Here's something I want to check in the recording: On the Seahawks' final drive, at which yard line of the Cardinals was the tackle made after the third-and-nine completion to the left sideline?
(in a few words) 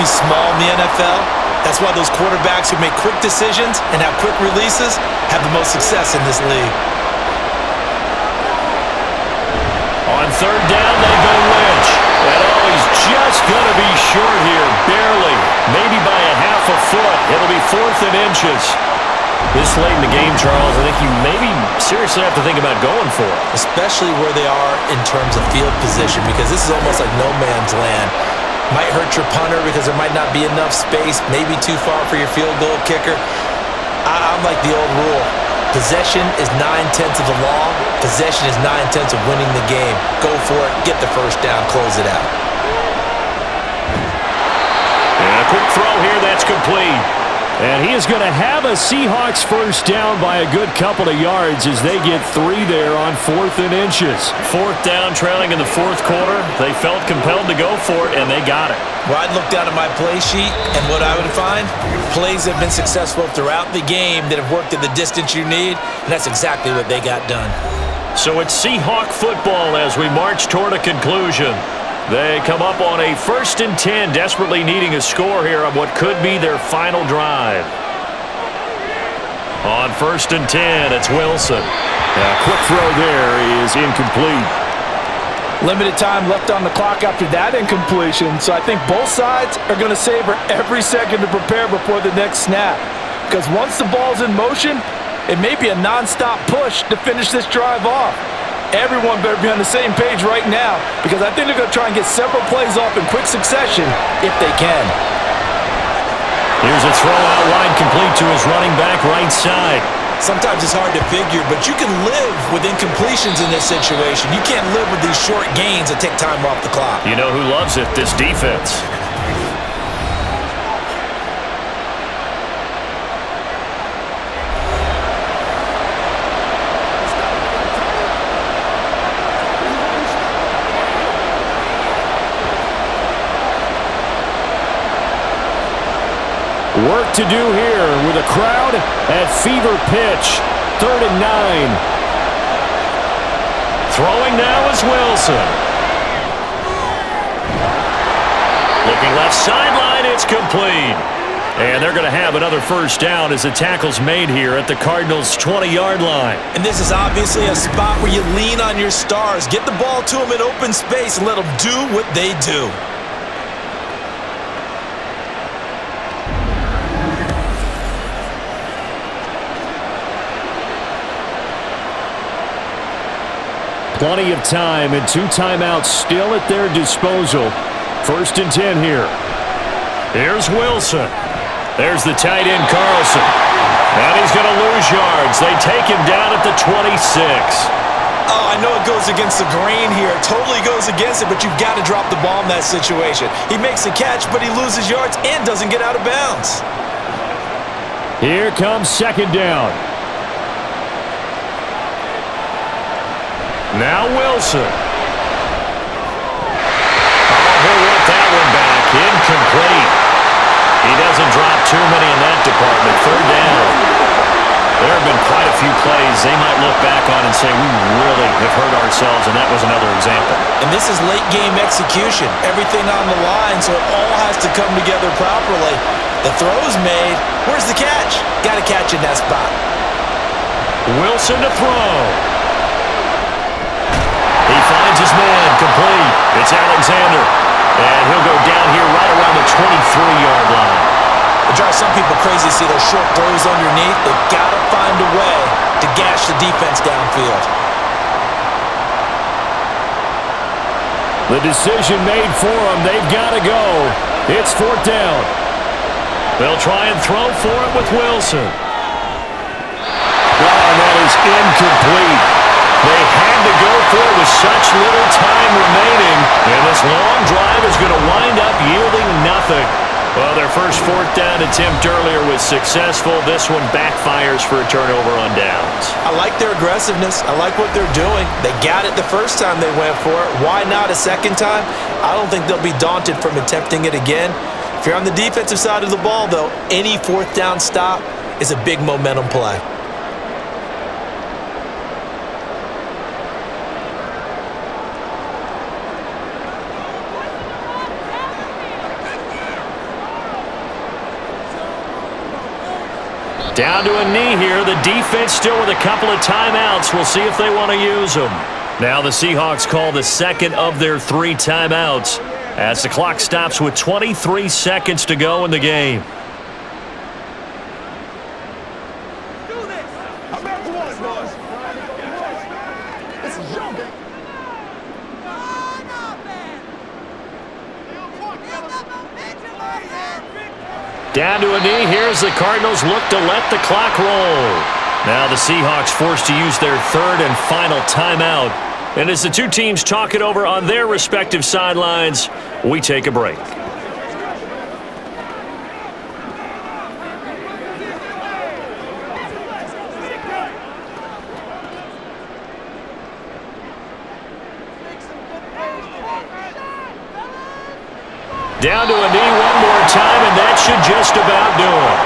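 20.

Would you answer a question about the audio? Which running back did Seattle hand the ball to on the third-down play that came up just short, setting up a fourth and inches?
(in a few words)
Lynch.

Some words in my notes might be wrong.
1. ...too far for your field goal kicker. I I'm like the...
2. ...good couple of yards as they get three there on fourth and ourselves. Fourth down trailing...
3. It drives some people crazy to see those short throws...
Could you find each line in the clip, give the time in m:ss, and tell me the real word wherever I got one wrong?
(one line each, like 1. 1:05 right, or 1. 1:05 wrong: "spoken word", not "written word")
1. 0:31 right
2. 0:50 wrong: "inches", not "ourselves"
3. 4:01 right.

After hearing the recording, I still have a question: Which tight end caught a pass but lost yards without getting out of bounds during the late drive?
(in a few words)
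Carlson.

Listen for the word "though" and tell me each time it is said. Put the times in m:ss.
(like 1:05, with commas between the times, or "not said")
4:46.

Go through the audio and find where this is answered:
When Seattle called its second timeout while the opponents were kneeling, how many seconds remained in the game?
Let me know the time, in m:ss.
5:13.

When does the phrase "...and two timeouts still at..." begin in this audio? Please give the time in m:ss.
2:54.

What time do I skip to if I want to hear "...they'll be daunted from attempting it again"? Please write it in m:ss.
4:42.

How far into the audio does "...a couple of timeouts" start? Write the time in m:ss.
5:05.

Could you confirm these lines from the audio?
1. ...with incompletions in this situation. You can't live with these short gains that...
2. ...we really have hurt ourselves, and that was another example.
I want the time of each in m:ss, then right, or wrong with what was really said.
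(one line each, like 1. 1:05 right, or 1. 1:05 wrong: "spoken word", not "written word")
1. 1:52 right
2. 3:37 right.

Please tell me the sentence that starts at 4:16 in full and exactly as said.
They'll try and throw for it with Wilson.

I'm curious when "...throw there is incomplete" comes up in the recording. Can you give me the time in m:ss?
1:22.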